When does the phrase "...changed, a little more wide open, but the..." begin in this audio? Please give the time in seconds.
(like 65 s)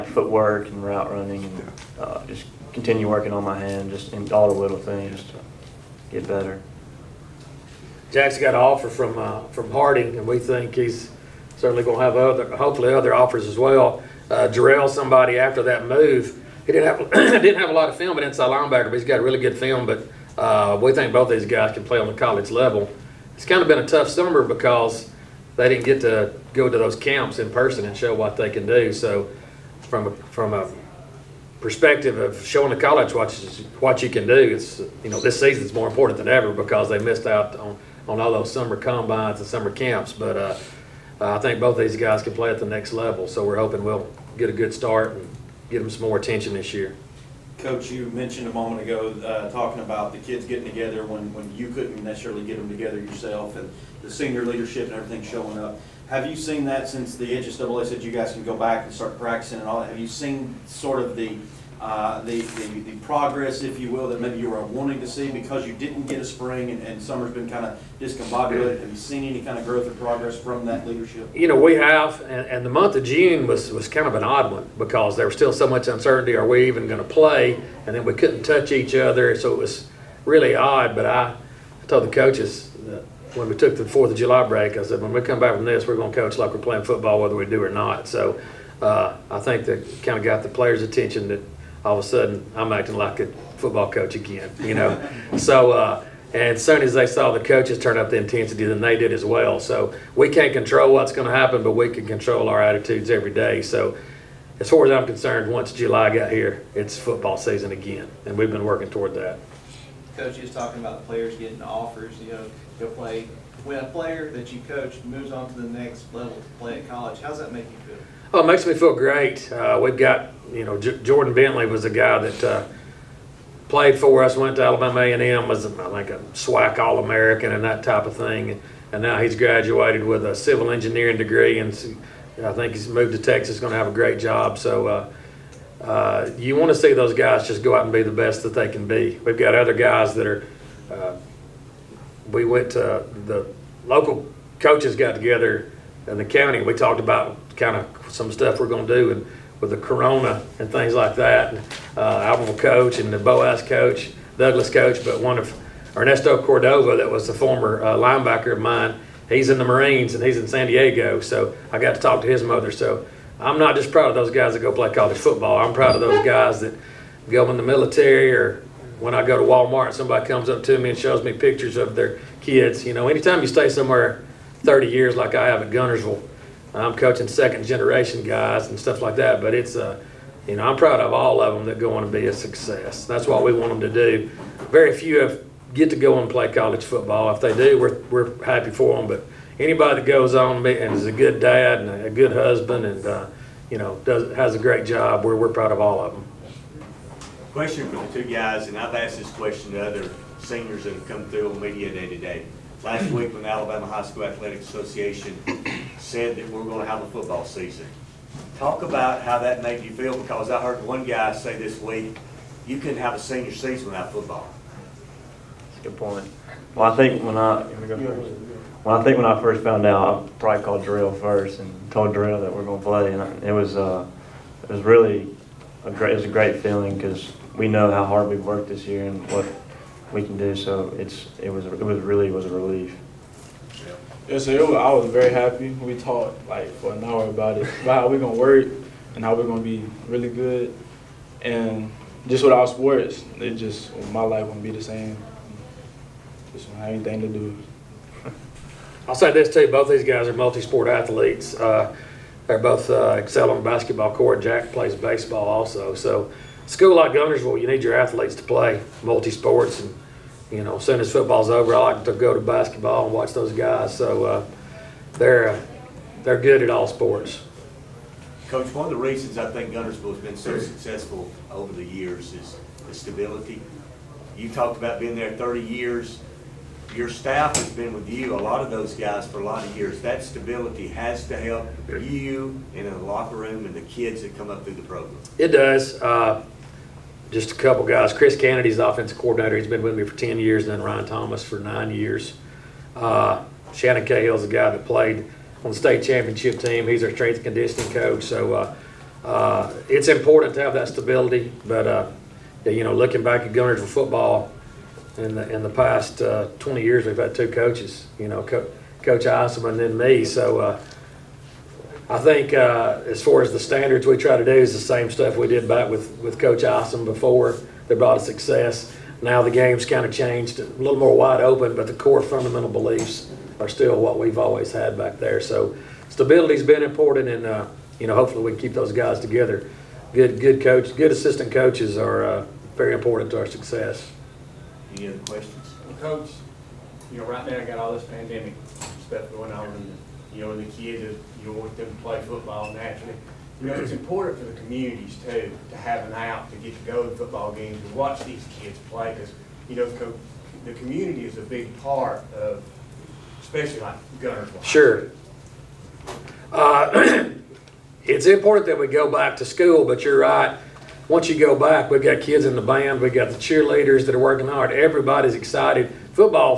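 320 s.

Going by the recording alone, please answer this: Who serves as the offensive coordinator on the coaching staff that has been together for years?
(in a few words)
Chris Kennedy.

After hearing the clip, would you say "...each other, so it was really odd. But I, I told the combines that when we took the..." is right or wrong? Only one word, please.
wrong.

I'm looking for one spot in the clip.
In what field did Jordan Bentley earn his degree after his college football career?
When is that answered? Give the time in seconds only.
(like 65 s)
130 s.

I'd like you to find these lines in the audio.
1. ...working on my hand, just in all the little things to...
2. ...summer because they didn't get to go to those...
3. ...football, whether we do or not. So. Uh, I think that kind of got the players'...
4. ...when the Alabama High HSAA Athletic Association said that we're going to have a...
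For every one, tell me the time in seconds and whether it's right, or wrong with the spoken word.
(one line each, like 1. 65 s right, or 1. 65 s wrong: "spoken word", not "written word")
1. 3 s right
2. 24 s right
3. 86 s right
4. 203 s wrong: "School", not "HSAA".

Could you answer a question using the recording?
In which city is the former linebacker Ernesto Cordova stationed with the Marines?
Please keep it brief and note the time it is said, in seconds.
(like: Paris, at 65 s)
San Diego, at 160 s.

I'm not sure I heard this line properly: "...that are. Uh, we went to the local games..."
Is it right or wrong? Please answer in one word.
wrong.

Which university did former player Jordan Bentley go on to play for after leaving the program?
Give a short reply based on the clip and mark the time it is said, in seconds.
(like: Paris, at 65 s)
Alabama A&M, at 124 s.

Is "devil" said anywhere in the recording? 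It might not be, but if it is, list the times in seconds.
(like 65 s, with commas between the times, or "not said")
not said.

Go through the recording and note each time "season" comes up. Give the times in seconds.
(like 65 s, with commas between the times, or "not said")
35 s, 107 s, 207 s, 213 s.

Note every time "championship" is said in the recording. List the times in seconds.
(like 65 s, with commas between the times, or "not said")
296 s.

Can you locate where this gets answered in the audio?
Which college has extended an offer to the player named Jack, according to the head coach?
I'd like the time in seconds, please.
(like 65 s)
9 s.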